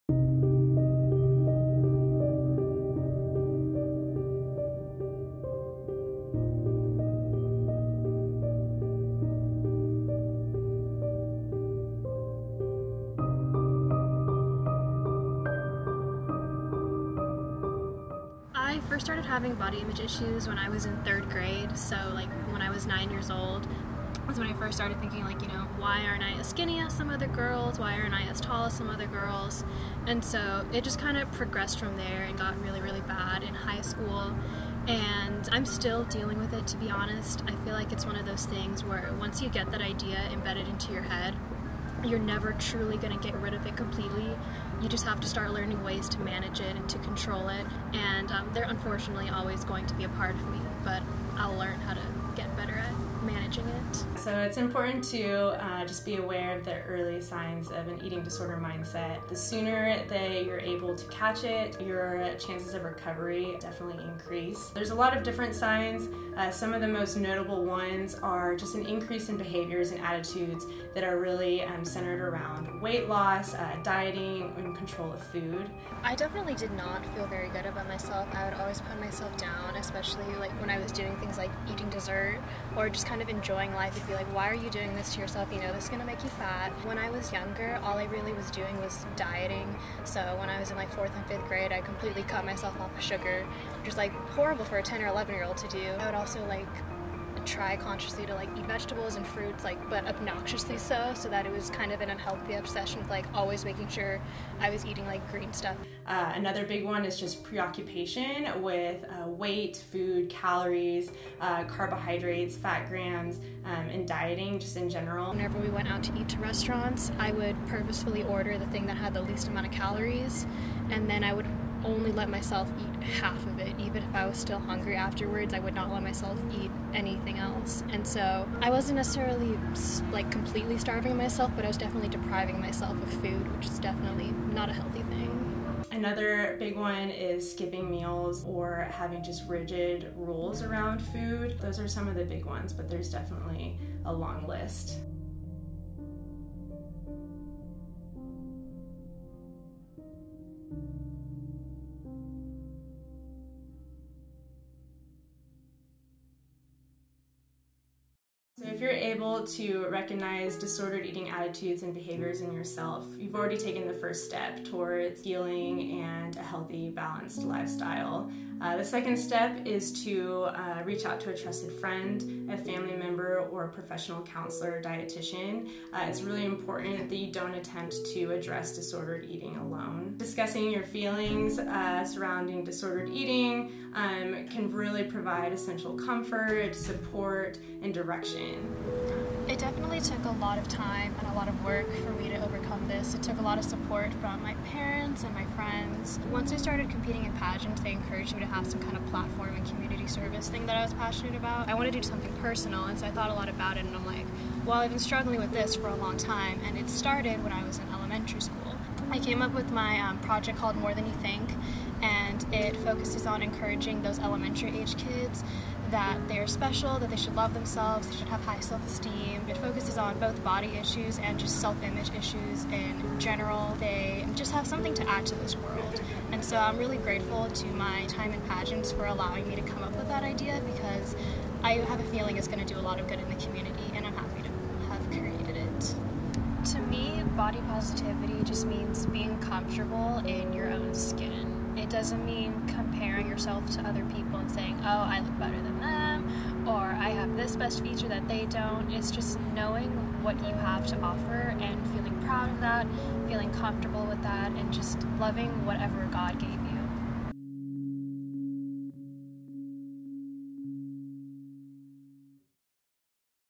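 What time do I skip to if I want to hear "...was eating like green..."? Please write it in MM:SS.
01:44.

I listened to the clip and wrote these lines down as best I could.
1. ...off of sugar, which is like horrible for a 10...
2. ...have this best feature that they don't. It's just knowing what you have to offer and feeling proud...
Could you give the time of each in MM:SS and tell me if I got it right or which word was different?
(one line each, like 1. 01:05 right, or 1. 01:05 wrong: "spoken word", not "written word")
1. 01:32 right
2. 04:07 right.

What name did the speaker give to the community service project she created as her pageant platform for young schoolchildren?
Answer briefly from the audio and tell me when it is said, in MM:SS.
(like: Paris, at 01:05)
More Than You Think, at 03:30.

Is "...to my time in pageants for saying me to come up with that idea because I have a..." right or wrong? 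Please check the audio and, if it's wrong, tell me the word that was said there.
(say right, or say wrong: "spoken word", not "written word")
wrong: "allowing", not "saying".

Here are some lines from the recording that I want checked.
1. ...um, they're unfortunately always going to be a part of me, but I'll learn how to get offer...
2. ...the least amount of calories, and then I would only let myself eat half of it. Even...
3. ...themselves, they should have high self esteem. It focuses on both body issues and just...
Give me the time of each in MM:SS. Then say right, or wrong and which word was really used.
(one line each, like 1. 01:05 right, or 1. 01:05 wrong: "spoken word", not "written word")
1. 00:48 wrong: "better", not "offer"
2. 01:59 right
3. 03:37 right.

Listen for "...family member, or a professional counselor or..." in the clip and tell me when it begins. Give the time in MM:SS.
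02:52.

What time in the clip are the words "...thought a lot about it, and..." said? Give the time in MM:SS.
03:23.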